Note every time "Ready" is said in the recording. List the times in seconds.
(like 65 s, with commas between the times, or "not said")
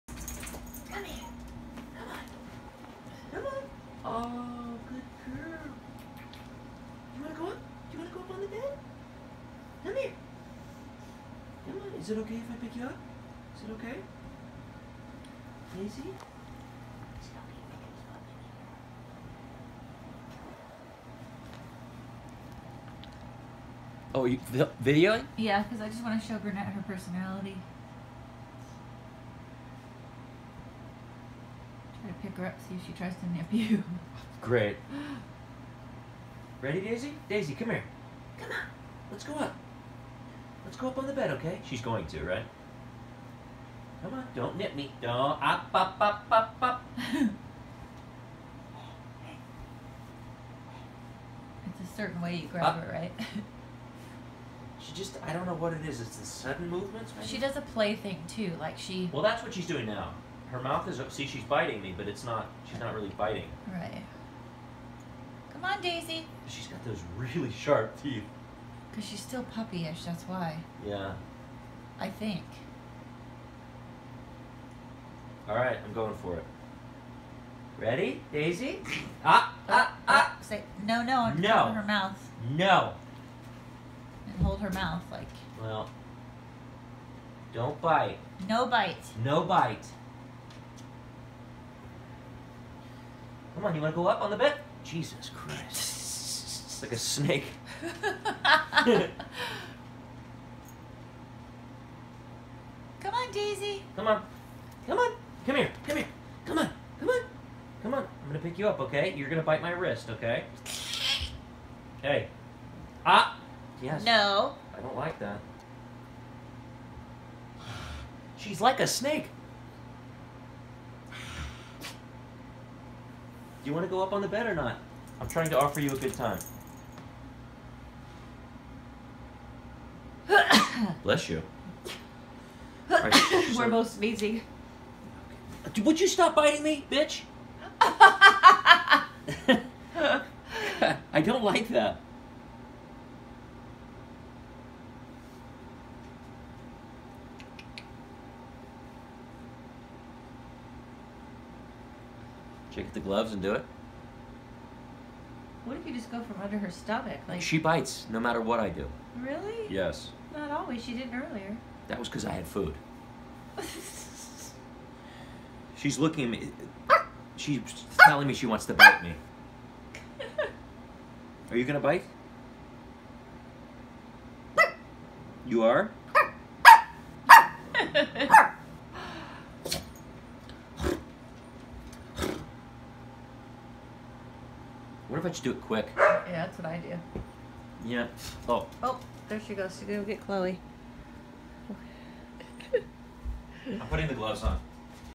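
36 s, 77 s.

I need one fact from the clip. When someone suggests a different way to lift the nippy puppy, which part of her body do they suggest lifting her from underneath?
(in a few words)
Her stomach.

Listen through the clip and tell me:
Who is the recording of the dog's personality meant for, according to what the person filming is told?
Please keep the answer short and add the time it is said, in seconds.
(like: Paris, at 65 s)
Burnett, at 26 s.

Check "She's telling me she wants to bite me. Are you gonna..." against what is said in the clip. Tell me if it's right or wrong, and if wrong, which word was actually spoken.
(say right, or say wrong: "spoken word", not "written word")
right.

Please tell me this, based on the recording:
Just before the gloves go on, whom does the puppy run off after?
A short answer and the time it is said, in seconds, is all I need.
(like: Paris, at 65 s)
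Chloe, at 190 s.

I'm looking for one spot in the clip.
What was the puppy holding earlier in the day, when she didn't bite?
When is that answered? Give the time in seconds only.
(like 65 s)
162 s.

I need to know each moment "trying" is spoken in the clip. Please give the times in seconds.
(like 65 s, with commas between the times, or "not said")
125 s.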